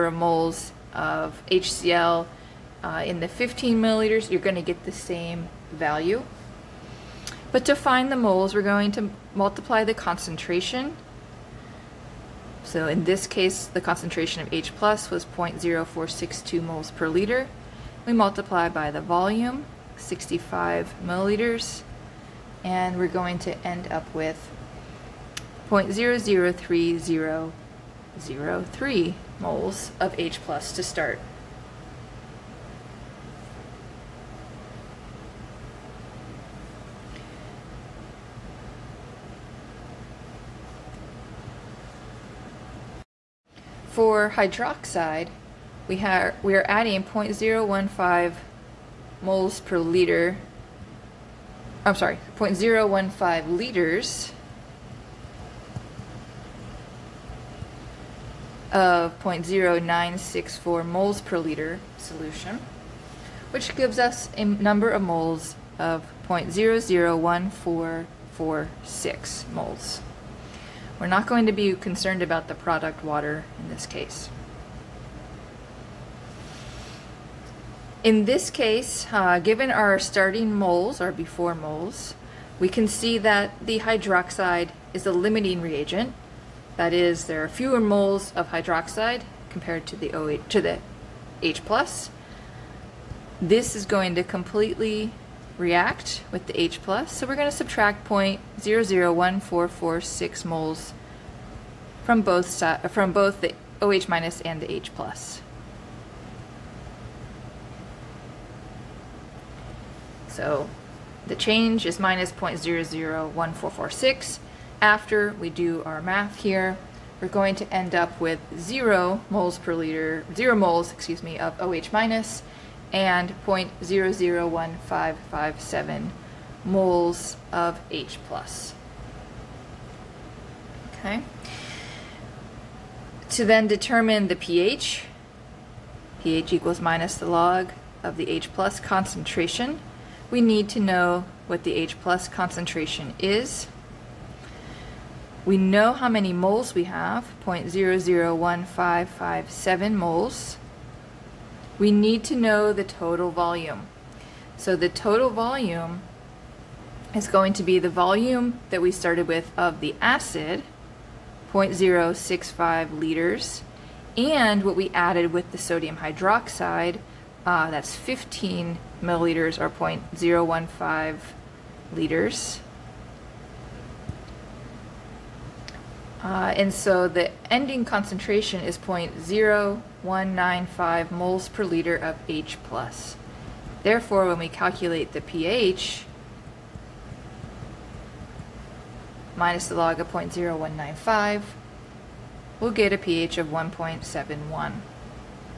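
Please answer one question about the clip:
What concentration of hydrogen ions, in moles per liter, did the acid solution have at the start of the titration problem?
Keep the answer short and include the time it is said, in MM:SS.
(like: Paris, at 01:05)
0.0462, at 00:15.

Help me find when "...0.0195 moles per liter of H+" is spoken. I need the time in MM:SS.
02:58.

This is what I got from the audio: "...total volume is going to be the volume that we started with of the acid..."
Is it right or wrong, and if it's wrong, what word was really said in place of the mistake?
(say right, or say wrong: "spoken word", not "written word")
right.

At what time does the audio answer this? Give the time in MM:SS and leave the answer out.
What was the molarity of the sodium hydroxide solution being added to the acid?
00:59.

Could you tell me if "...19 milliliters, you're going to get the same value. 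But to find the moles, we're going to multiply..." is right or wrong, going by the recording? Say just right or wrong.
wrong.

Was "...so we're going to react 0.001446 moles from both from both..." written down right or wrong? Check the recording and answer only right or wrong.
wrong.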